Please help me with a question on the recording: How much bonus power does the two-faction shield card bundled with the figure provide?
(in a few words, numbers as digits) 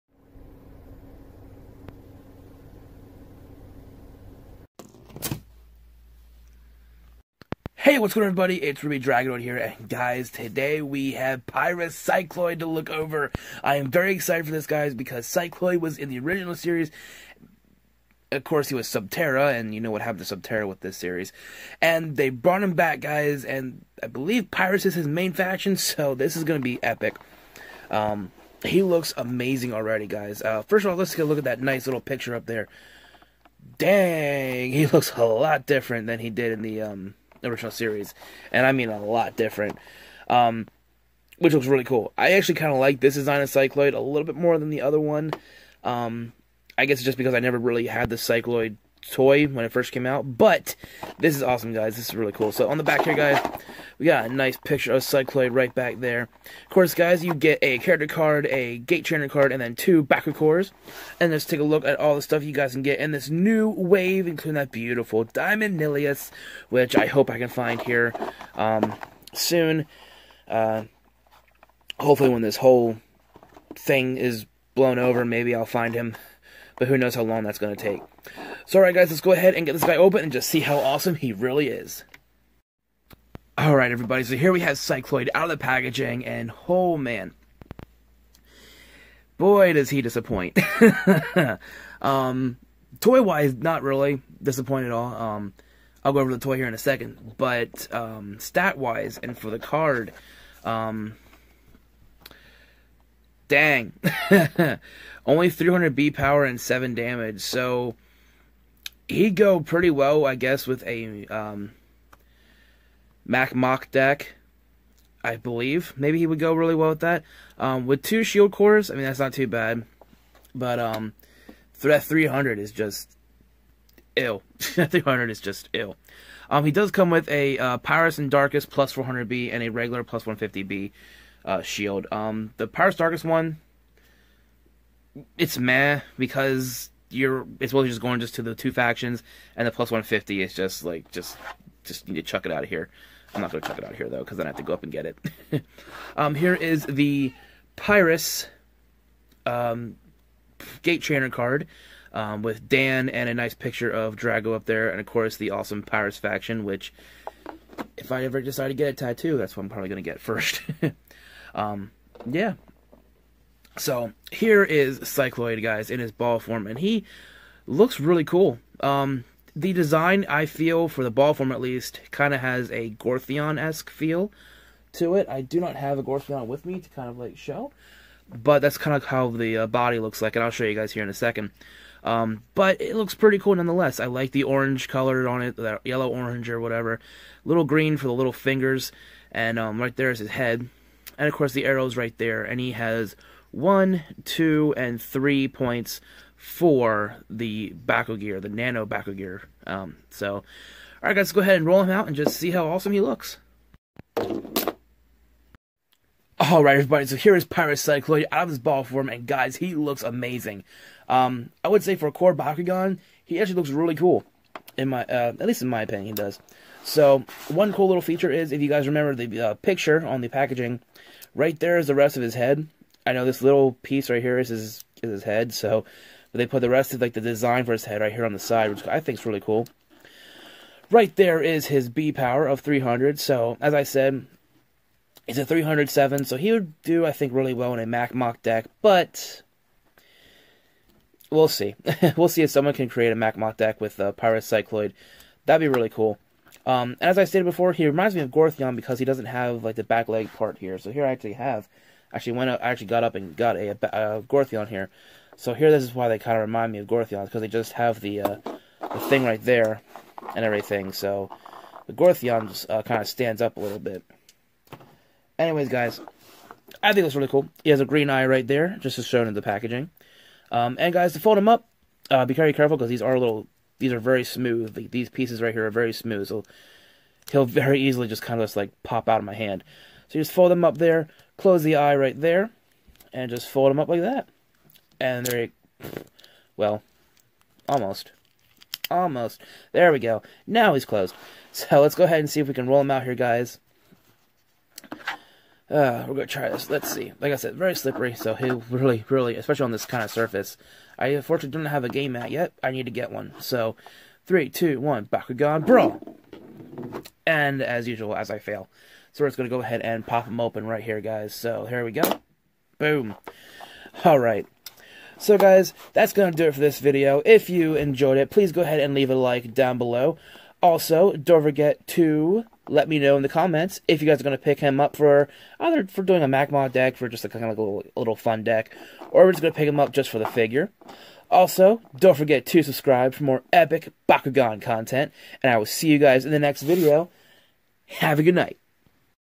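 +400B.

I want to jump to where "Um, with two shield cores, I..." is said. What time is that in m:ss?
1:57.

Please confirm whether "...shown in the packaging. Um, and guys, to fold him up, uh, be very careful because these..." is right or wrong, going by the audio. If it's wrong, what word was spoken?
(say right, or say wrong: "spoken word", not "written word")
right.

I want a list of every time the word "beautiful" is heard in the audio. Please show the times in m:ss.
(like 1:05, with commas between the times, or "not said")
1:04.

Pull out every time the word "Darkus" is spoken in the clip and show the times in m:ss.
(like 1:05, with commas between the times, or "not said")
2:08, 2:12.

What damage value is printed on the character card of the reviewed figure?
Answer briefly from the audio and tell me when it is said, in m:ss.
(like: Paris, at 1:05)
7, at 1:46.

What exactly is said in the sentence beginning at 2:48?
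Um, the design, I feel, for the ball form at least, kind of has a Gorthion-esque feel to it.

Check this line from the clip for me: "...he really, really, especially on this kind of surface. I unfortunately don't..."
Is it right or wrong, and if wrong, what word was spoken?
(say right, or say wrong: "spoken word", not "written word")
right.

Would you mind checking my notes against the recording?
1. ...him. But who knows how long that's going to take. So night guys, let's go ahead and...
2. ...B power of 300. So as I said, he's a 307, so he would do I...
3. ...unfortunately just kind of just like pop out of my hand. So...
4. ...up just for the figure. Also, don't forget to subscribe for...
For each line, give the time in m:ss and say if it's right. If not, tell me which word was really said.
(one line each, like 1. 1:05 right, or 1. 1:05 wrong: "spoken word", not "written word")
1. 1:15 wrong: "alright", not "night"
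2. 3:51 right
3. 4:37 wrong: "easily", not "unfortunately"
4. 5:29 right.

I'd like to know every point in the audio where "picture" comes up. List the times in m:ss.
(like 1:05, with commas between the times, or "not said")
0:31, 0:54, 2:33, 3:39.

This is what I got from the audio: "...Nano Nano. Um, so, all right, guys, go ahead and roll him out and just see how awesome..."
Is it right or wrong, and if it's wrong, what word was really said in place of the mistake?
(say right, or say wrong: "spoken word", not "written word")
wrong: "Gear", not "Nano".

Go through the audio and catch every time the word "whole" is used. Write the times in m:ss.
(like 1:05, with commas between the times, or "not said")
1:12.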